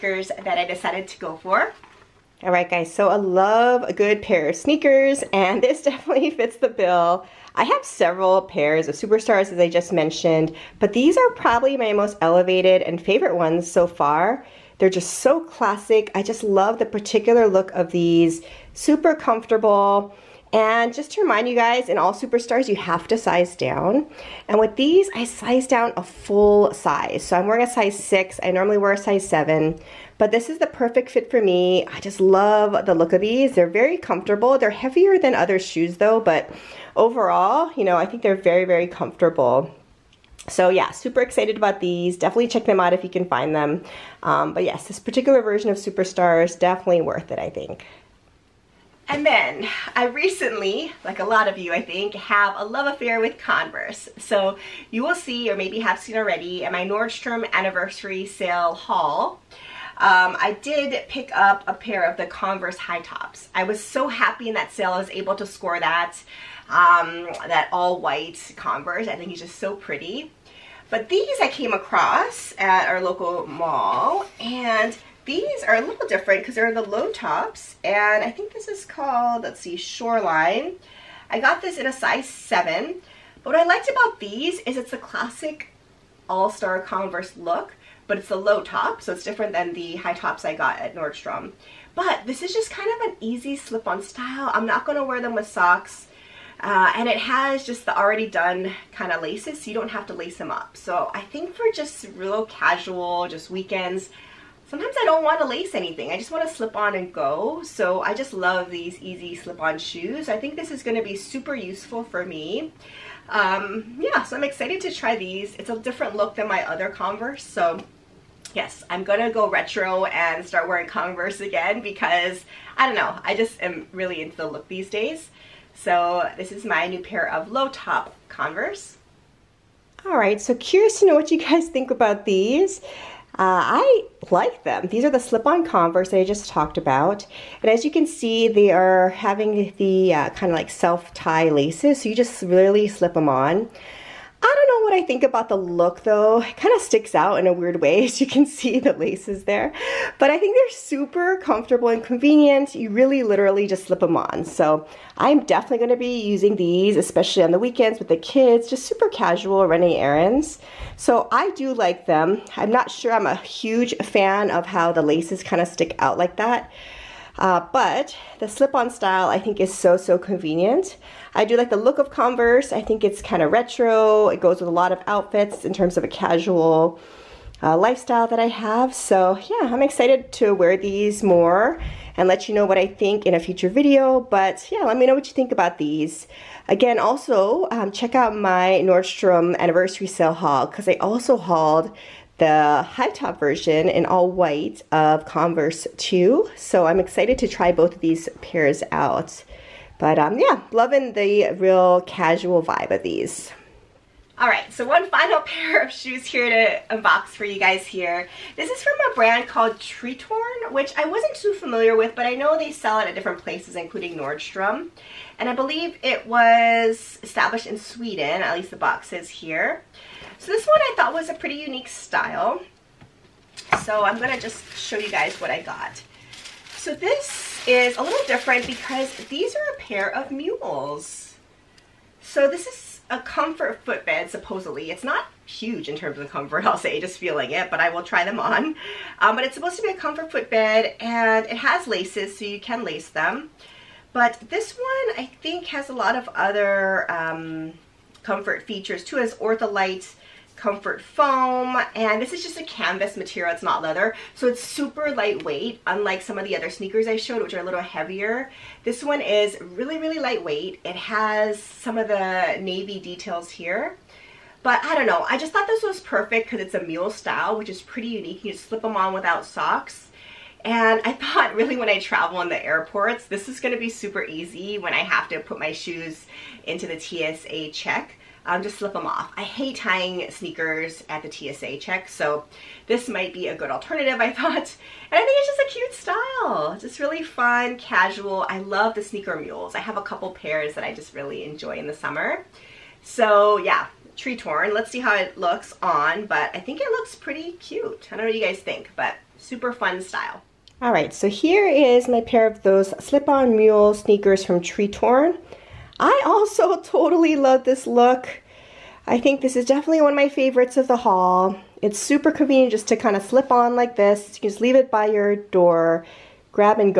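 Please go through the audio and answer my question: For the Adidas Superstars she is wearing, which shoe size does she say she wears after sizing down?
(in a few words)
6.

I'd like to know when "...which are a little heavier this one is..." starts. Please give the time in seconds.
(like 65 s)
257 s.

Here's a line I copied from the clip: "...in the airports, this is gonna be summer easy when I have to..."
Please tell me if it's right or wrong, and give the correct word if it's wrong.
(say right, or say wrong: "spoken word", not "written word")
wrong: "super", not "summer".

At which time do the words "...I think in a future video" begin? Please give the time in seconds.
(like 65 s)
182 s.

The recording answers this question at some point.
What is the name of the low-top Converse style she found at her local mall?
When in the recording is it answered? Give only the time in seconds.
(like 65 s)
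79 s.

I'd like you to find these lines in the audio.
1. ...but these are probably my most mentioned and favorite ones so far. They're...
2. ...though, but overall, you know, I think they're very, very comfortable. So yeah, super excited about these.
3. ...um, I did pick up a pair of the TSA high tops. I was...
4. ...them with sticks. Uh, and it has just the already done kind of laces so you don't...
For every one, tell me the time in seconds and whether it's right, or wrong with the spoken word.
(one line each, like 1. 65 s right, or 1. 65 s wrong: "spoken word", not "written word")
1. 10 s wrong: "elevated", not "mentioned"
2. 35 s right
3. 59 s wrong: "Converse", not "TSA"
4. 95 s wrong: "socks", not "sticks".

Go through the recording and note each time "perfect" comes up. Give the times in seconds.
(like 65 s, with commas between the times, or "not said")
30 s, 266 s.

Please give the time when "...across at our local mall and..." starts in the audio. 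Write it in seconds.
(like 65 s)
71 s.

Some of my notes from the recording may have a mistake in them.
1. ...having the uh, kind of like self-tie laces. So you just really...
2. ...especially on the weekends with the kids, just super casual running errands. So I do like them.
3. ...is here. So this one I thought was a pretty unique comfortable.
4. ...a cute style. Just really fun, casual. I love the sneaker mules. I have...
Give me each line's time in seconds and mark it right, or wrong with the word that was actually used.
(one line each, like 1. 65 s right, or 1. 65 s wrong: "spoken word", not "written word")
1. 139 s right
2. 156 s right
3. 219 s wrong: "style", not "comfortable"
4. 285 s right.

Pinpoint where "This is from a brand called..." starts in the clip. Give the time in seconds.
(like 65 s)
208 s.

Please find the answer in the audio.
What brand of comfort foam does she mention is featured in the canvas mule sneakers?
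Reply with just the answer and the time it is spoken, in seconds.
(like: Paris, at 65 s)
Ortholite, at 249 s.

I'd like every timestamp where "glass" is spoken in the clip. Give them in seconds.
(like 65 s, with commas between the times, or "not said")
not said.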